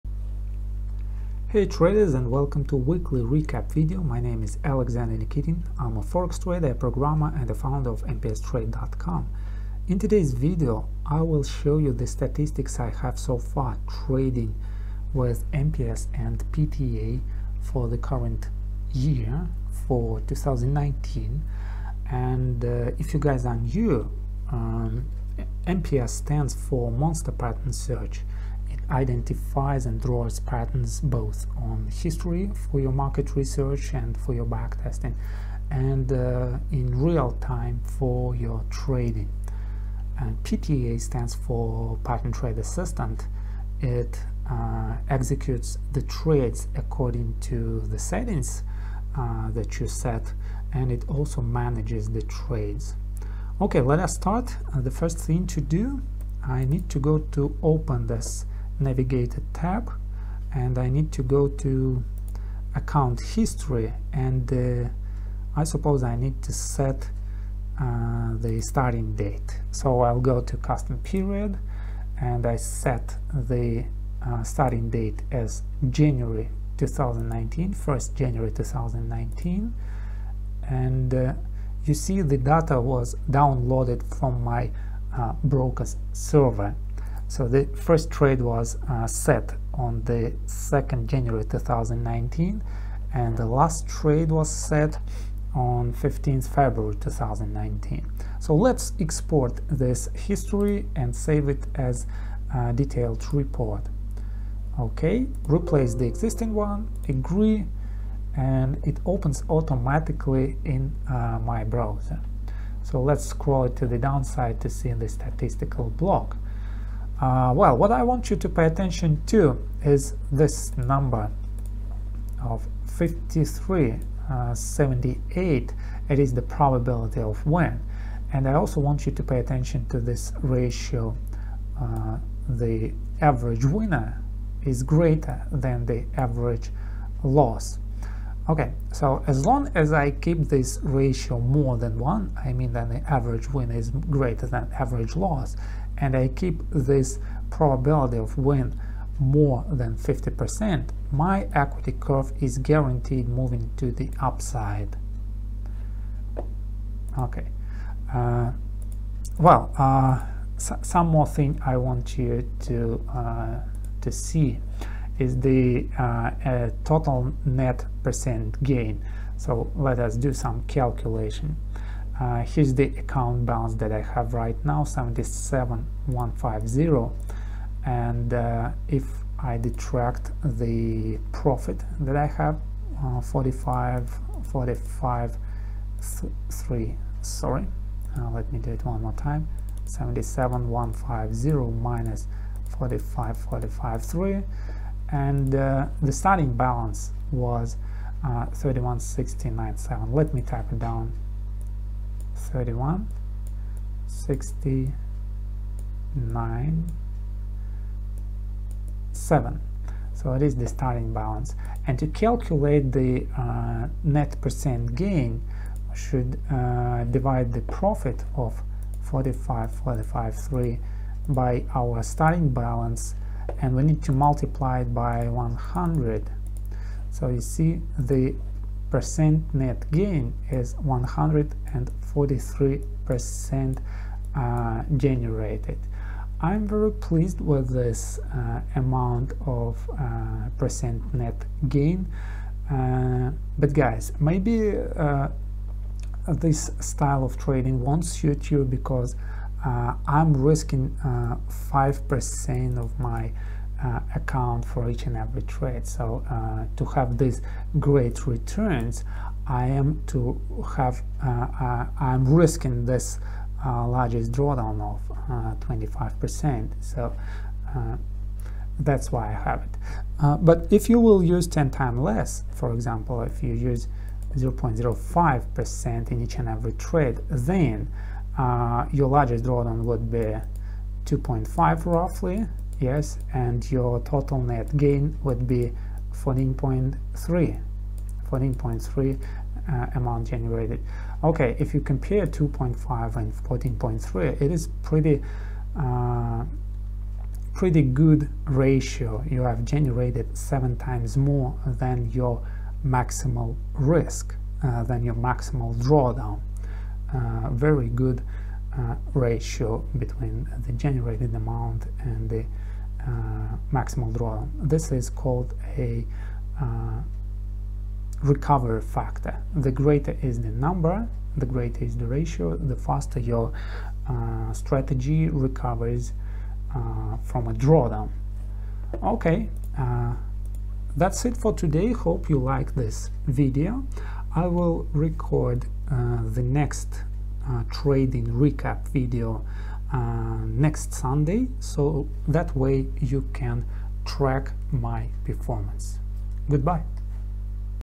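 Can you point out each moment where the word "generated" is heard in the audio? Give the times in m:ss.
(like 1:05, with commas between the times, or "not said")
3:54, 4:50, 4:59, 5:10.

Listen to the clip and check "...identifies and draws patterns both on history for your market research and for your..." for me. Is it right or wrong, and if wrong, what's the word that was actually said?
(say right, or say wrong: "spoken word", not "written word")
right.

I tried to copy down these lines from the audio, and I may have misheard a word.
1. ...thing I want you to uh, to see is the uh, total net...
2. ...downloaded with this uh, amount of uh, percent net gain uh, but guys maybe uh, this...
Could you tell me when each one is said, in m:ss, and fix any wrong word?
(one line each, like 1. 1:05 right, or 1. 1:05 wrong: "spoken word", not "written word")
1. 2:41 right
2. 3:56 wrong: "pleased", not "downloaded".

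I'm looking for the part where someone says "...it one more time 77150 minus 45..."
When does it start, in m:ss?
3:08.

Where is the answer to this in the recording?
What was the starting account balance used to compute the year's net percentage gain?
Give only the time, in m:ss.
3:22.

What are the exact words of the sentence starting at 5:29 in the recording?
Okay, uh, that's it for today.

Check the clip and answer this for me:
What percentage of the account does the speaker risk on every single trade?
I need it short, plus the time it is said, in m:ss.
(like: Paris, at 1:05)
5%, at 4:11.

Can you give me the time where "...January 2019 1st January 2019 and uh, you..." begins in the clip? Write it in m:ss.
1:15.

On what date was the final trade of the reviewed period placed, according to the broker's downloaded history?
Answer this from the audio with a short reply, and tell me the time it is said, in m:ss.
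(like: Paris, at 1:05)
15th February 2019, at 1:35.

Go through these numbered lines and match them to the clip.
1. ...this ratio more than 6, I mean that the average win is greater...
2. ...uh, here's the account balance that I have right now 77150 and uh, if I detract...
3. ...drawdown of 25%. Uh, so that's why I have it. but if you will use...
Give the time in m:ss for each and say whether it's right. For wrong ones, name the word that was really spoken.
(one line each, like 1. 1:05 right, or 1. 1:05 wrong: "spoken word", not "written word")
1. 2:20 wrong: "1", not "6"
2. 2:52 right
3. 4:24 right.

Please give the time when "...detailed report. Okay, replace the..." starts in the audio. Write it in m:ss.
1:42.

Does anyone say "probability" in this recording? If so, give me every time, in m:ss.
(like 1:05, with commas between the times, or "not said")
2:06, 2:27.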